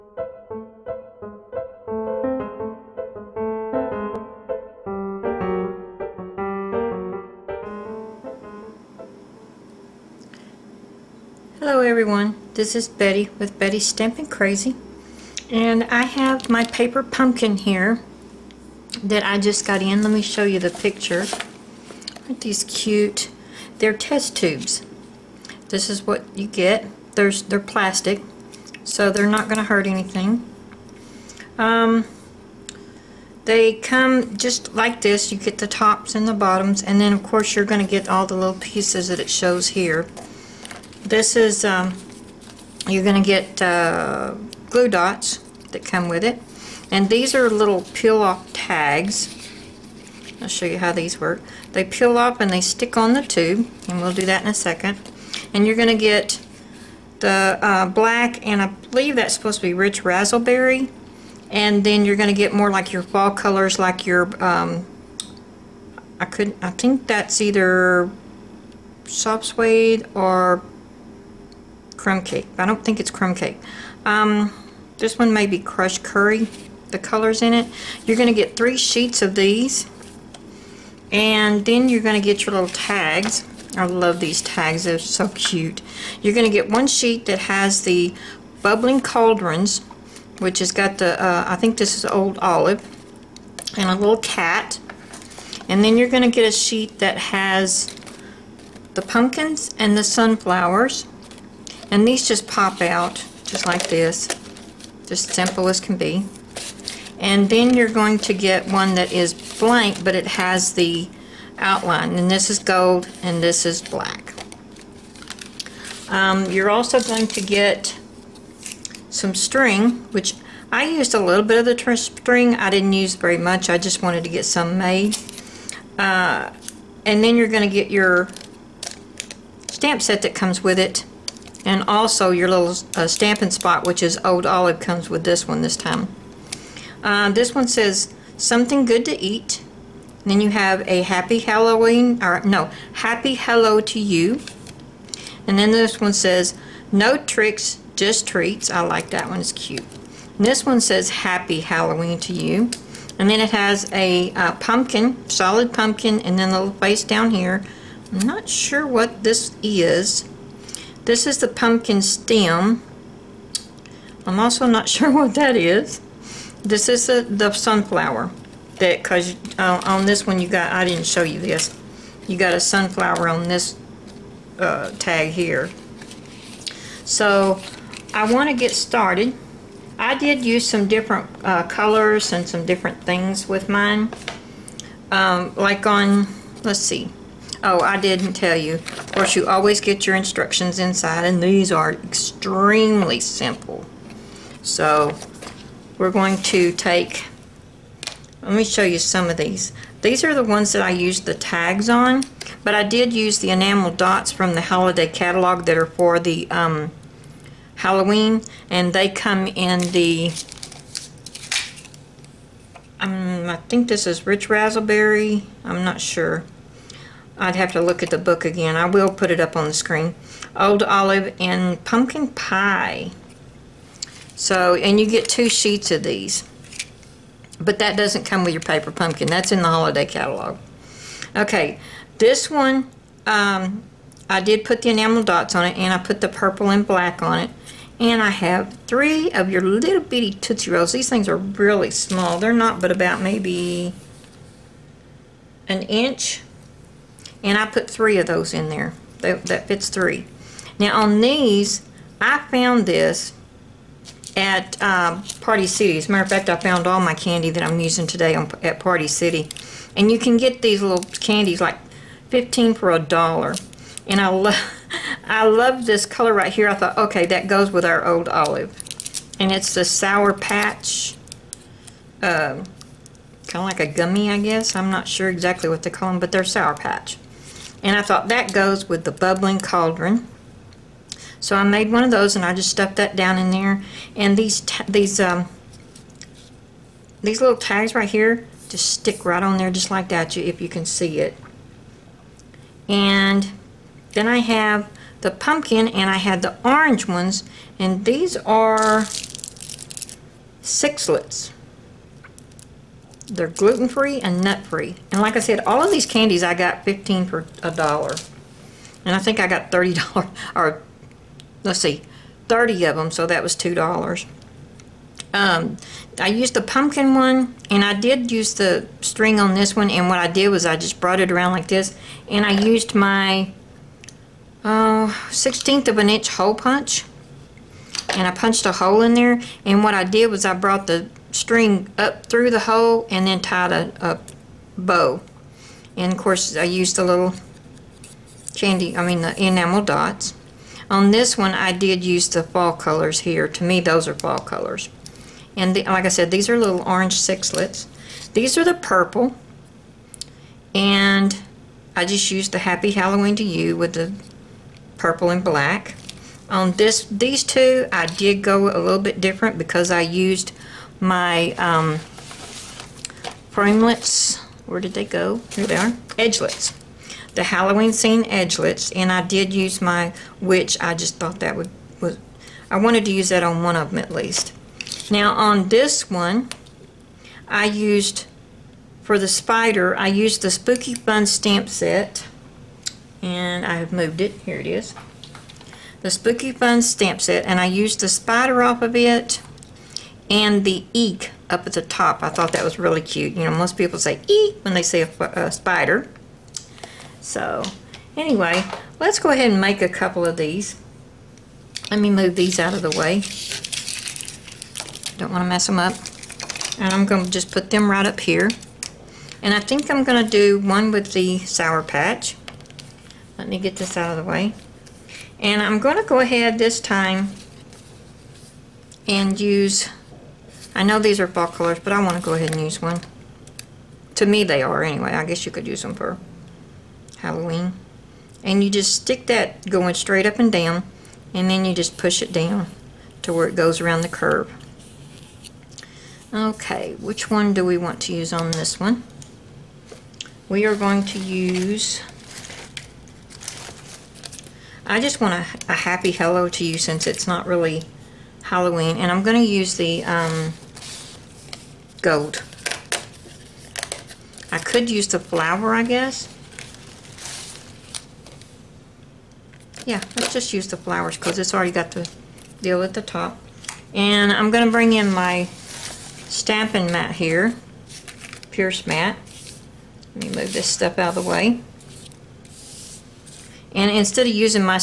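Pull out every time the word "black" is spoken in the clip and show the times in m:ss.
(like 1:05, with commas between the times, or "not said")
0:57, 1:53, 3:56, 5:55.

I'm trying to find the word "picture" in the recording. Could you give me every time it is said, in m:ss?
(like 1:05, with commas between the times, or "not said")
0:20.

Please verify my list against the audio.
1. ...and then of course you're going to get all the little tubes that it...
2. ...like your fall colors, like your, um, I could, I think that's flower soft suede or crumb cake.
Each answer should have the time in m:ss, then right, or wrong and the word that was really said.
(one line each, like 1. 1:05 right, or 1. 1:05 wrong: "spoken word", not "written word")
1. 0:36 wrong: "pieces", not "tubes"
2. 1:02 wrong: "either", not "flower".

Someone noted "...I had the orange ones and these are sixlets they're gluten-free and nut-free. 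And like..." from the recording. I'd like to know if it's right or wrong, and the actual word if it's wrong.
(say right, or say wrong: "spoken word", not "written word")
right.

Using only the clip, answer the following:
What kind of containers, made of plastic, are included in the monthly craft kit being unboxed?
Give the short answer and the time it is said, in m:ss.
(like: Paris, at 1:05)
Test tubes, at 0:23.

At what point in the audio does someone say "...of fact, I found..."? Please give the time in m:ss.
4:16.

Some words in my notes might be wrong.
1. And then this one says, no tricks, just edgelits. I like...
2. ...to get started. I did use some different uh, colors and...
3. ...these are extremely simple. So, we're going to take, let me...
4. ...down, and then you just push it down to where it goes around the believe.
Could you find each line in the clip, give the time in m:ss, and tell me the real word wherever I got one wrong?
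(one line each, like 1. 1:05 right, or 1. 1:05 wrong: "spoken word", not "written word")
1. 2:25 wrong: "treats", not "edgelits"
2. 2:58 right
3. 3:11 right
4. 7:10 wrong: "curve", not "believe".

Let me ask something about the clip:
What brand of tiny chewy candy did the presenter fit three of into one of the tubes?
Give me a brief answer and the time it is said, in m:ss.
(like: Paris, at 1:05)
Tootsie Rolls, at 4:00.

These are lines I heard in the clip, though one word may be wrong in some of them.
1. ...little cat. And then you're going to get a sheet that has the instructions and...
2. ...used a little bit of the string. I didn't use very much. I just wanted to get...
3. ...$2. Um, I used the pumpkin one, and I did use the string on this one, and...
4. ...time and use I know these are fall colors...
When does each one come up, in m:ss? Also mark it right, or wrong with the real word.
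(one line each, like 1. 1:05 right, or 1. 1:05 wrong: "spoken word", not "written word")
1. 1:33 wrong: "pumpkins", not "instructions"
2. 2:00 right
3. 5:13 right
4. 6:56 right.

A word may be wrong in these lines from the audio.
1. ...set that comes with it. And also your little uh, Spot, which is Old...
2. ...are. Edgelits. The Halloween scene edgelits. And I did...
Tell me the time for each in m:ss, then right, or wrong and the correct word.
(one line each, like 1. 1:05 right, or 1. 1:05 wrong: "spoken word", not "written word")
1. 2:10 right
2. 6:05 right.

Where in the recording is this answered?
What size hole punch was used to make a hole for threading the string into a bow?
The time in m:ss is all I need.
5:25.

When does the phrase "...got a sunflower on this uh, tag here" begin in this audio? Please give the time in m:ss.
2:52.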